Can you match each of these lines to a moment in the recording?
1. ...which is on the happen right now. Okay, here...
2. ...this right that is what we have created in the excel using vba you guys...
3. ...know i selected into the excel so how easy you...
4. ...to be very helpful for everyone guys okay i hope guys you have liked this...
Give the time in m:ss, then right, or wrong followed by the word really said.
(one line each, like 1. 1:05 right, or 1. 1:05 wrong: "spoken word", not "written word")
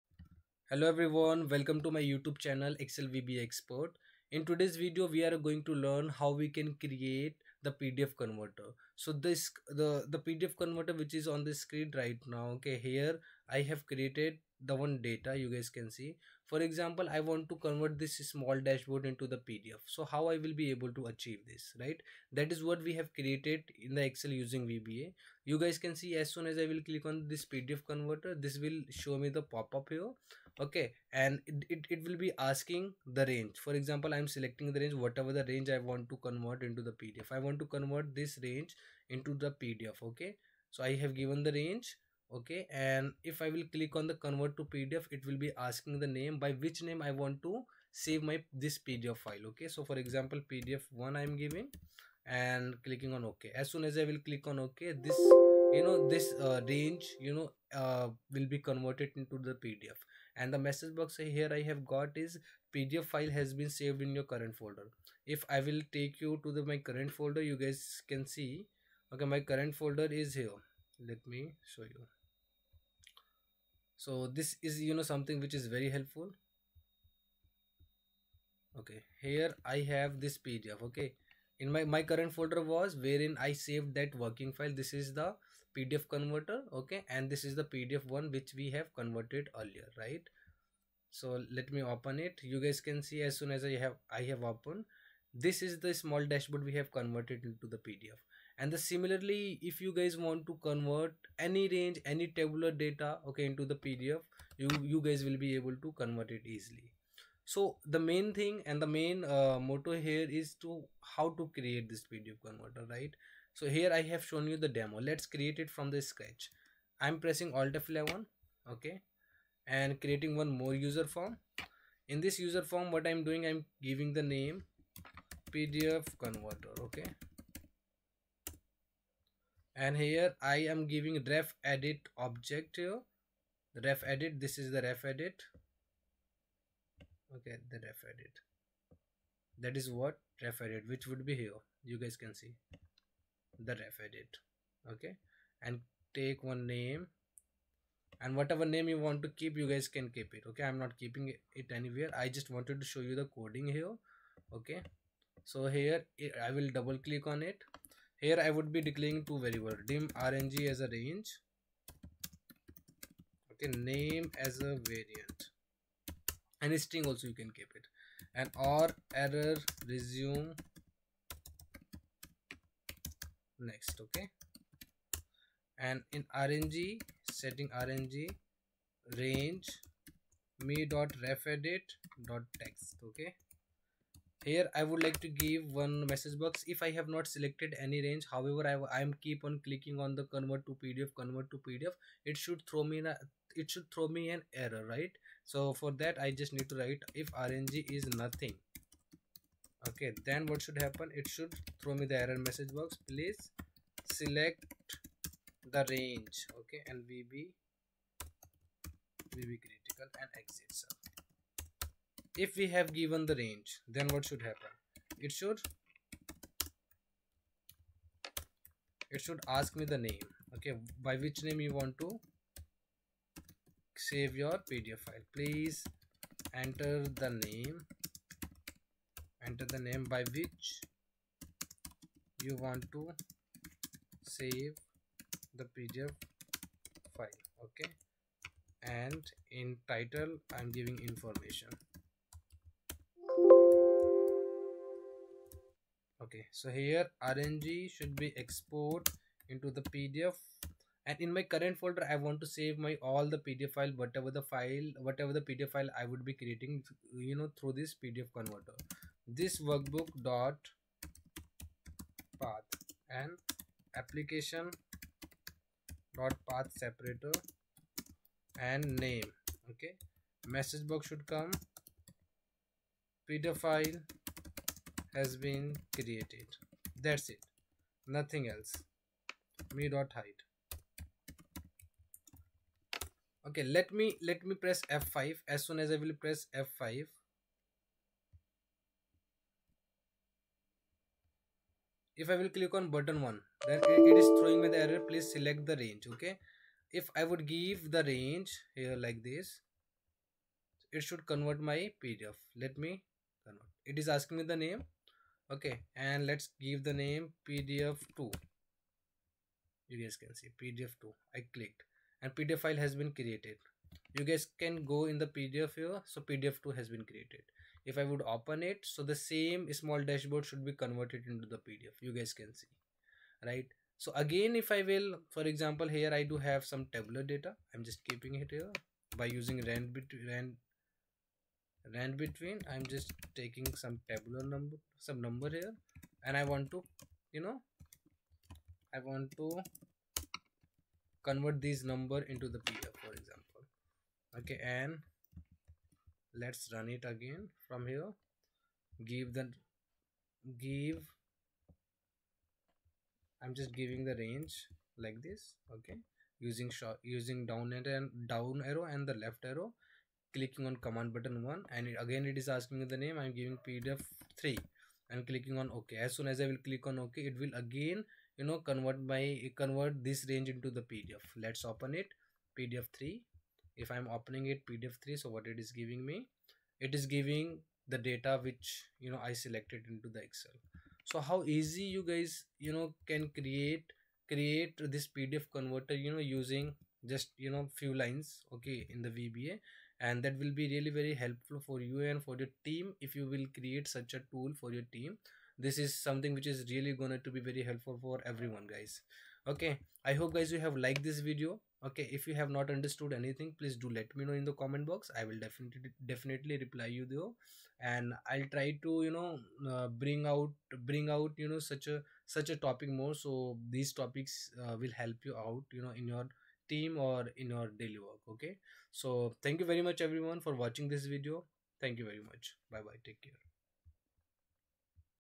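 1. 0:10 wrong: "screen", not "happen"
2. 0:21 right
3. 6:19 right
4. 6:37 right.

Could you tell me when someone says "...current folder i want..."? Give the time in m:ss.
4:11.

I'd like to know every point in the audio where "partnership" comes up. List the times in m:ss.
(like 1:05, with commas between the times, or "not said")
not said.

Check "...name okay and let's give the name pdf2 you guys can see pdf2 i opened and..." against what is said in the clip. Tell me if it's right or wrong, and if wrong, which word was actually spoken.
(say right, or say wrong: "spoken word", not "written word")
wrong: "clicked", not "opened".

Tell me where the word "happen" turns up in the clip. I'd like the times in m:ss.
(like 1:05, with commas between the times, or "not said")
3:20, 3:34.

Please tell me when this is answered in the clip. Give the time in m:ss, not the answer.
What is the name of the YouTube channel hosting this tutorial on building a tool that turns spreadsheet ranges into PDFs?
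0:02.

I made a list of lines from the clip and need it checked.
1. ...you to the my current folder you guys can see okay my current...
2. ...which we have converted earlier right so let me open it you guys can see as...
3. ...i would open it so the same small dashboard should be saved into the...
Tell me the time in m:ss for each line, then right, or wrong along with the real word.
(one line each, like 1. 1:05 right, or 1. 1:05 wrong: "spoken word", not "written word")
1. 1:06 right
2. 1:28 right
3. 5:17 wrong: "converted", not "saved".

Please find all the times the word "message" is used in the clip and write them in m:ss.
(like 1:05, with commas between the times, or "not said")
1:00, 3:06, 3:22, 4:30.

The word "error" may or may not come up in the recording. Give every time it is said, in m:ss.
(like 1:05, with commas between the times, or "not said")
2:49, 3:14, 3:22, 4:54.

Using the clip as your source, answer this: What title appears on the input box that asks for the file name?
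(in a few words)
Information.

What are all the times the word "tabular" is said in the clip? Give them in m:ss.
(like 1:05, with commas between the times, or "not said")
1:42, 5:26, 5:34.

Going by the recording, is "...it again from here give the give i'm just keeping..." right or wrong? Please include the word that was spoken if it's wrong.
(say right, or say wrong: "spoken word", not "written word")
wrong: "giving", not "keeping".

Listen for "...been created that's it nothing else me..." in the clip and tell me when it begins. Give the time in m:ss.
4:35.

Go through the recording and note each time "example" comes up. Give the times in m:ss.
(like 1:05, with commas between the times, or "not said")
0:16, 0:33, 0:50, 5:25, 5:43.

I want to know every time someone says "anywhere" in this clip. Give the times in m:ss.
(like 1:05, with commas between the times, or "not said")
2:31.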